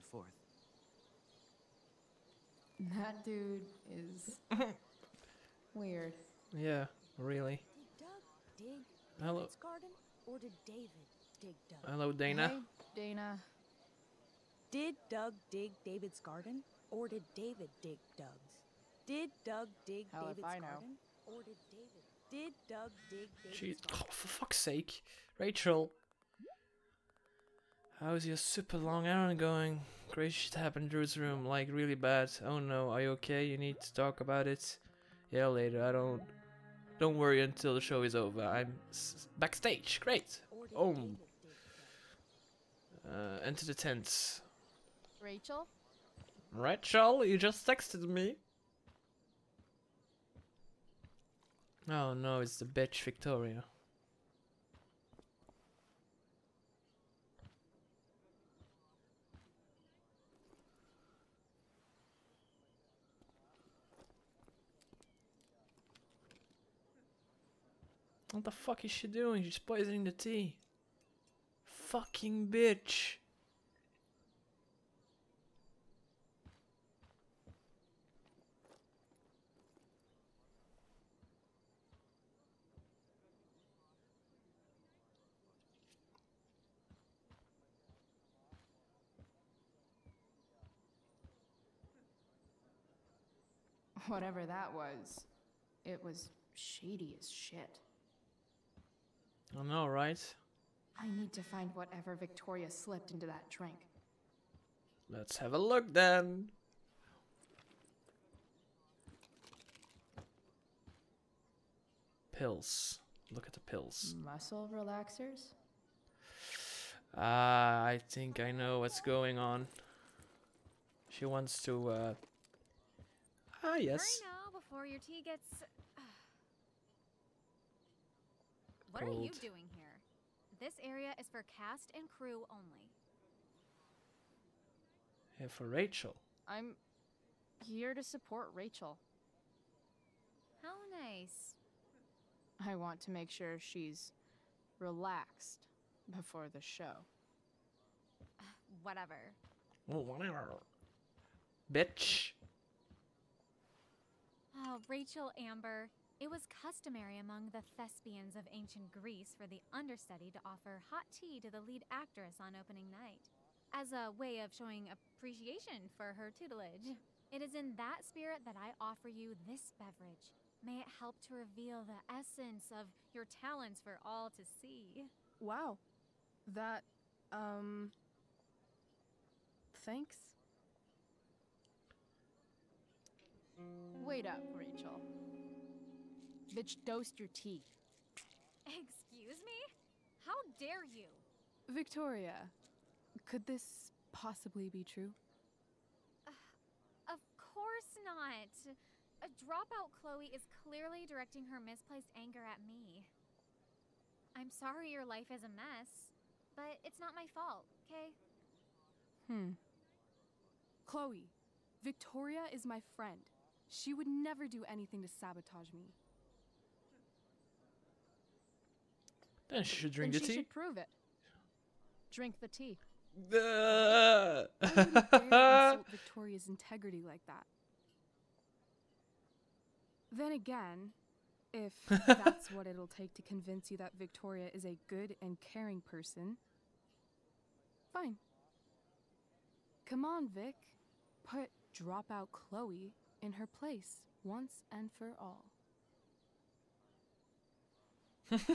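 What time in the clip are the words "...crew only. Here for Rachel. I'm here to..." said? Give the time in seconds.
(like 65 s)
132 s.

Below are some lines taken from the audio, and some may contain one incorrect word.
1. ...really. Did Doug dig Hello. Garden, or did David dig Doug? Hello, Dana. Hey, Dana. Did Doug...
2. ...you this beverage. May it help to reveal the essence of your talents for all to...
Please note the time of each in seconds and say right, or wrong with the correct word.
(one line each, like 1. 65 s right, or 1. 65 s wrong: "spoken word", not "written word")
1. 7 s right
2. 169 s right.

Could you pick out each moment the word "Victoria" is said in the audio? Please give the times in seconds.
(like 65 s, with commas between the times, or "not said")
53 s, 102 s, 191 s, 211 s, 225 s, 233 s.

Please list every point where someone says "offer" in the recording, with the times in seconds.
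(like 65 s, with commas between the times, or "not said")
160 s, 168 s.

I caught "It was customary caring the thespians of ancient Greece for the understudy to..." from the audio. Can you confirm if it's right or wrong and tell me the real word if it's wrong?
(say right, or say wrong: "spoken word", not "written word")
wrong: "among", not "caring".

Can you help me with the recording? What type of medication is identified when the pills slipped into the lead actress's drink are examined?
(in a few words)
Muscle relaxers.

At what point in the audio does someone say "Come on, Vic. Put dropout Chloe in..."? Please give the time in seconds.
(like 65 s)
239 s.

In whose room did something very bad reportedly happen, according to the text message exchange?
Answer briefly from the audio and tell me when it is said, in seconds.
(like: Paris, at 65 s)
Drew's room, at 30 s.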